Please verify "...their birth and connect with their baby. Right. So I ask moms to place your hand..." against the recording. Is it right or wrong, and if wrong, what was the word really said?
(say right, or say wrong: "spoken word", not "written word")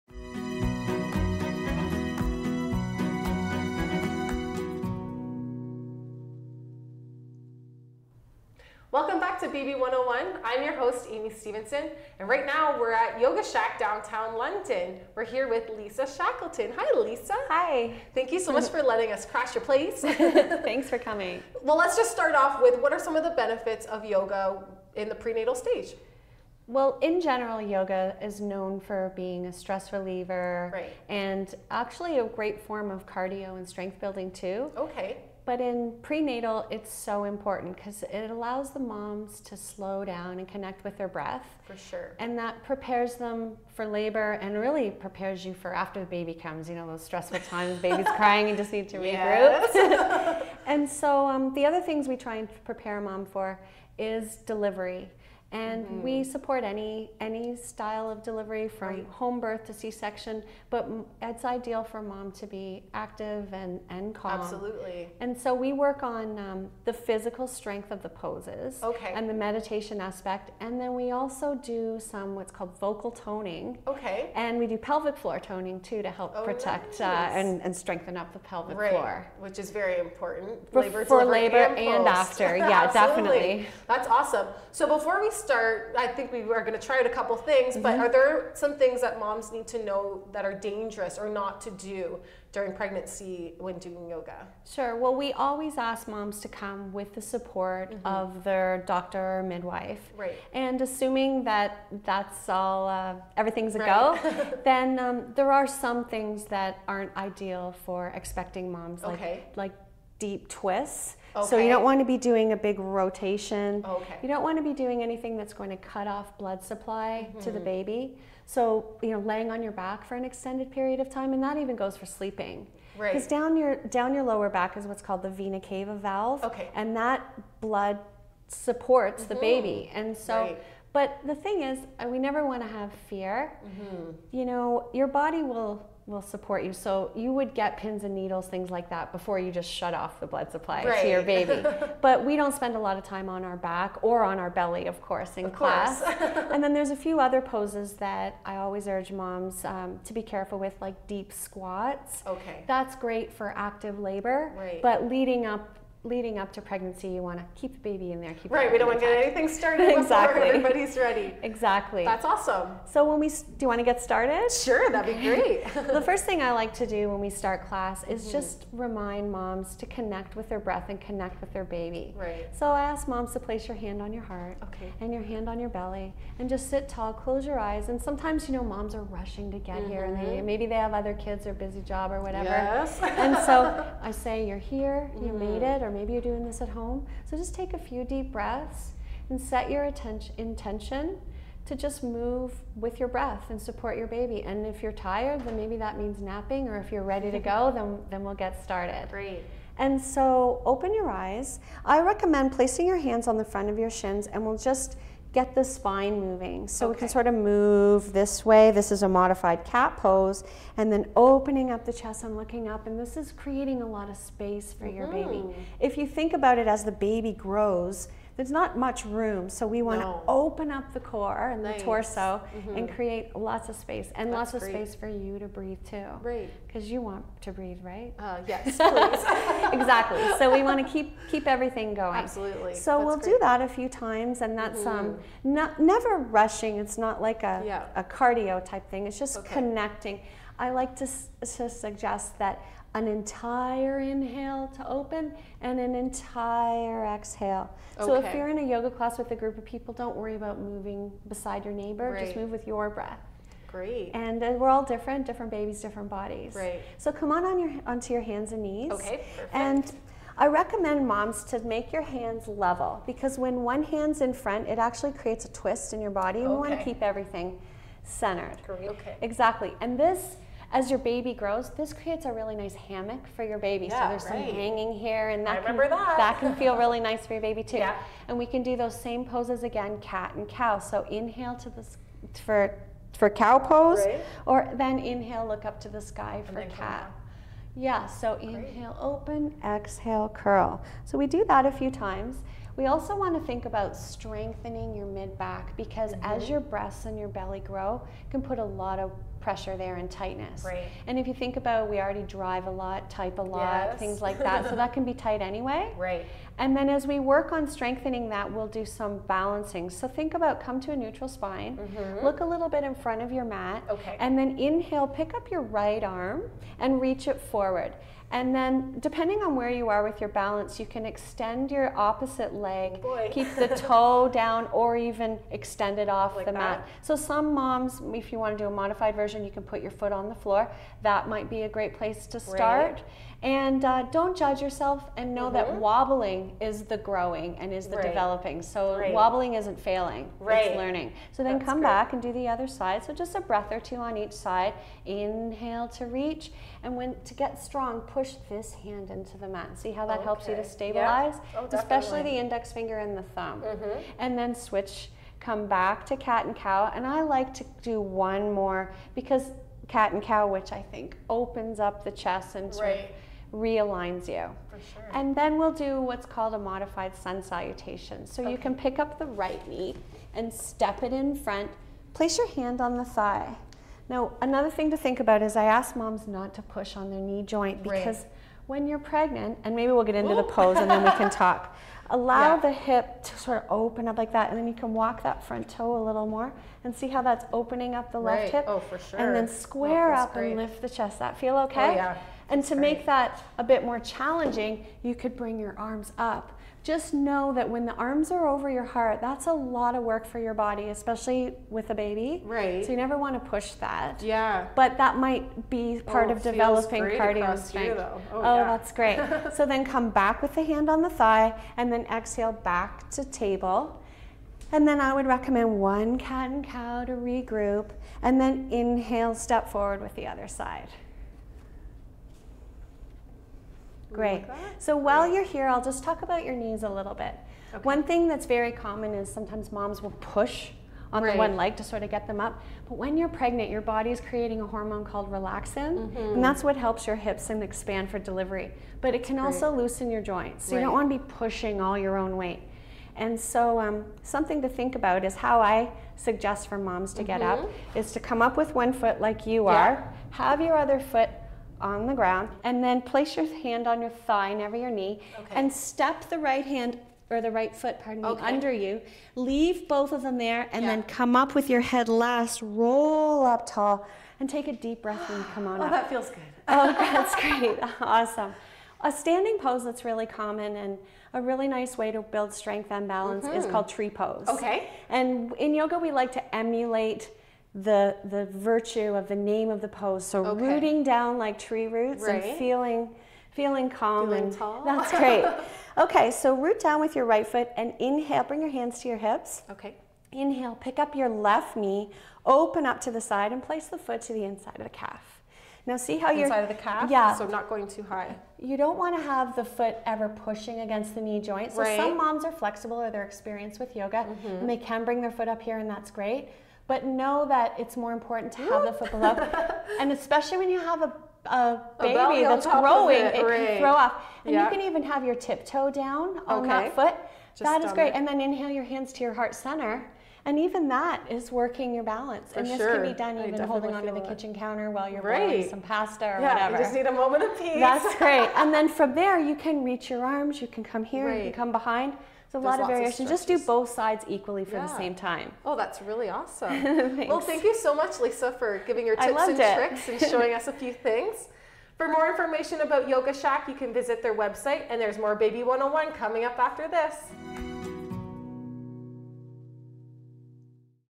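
wrong: "breath", not "birth".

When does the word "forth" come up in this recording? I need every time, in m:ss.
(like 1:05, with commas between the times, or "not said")
not said.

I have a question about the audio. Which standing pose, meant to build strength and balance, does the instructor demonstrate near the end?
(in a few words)
tree pose.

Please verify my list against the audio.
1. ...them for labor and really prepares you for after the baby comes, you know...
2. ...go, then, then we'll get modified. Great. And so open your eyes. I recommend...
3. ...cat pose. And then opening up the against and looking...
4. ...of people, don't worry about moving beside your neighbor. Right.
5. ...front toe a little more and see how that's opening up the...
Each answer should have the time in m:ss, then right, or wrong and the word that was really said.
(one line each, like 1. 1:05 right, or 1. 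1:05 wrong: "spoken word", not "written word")
1. 0:43 right
2. 3:17 wrong: "started", not "modified"
3. 3:29 wrong: "chest", not "against"
4. 4:09 right
5. 6:25 right.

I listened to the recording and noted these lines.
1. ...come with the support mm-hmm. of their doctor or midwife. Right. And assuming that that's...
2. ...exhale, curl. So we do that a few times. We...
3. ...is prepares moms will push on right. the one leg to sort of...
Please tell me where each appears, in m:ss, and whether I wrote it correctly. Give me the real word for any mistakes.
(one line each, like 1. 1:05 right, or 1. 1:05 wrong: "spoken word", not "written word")
1. 1:36 right
2. 4:49 right
3. 7:09 wrong: "sometimes", not "prepares".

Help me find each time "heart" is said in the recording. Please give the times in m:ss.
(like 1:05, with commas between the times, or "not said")
2:54, 6:38, 8:39.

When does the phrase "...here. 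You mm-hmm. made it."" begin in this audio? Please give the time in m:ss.
3:04.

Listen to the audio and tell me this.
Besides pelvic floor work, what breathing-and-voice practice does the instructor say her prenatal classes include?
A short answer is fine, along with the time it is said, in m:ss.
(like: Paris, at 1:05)
vocal toning, at 1:12.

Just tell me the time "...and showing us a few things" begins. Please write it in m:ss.
9:00.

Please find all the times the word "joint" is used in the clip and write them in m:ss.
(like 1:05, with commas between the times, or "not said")
6:17, 7:20, 8:21.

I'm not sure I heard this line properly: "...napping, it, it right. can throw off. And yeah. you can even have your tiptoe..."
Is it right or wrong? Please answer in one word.
wrong.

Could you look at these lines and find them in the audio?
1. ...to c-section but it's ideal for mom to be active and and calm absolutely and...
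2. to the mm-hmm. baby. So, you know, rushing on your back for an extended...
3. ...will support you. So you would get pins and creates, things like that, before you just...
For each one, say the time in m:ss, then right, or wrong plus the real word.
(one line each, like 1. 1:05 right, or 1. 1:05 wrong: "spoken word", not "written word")
1. 0:59 right
2. 1:57 wrong: "laying", not "rushing"
3. 2:16 wrong: "needles", not "creates".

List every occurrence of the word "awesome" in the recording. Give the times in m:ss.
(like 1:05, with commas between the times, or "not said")
1:24, 2:42, 7:48, 8:56.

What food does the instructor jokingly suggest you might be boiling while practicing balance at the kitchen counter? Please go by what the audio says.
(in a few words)
pasta.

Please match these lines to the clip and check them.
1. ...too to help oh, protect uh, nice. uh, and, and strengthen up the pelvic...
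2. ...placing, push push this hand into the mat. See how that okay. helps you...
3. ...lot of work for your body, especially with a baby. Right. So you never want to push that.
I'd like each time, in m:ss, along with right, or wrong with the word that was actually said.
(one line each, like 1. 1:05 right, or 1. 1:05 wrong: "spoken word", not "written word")
1. 1:15 right
2. 5:47 wrong: "strong", not "placing"
3. 6:39 right.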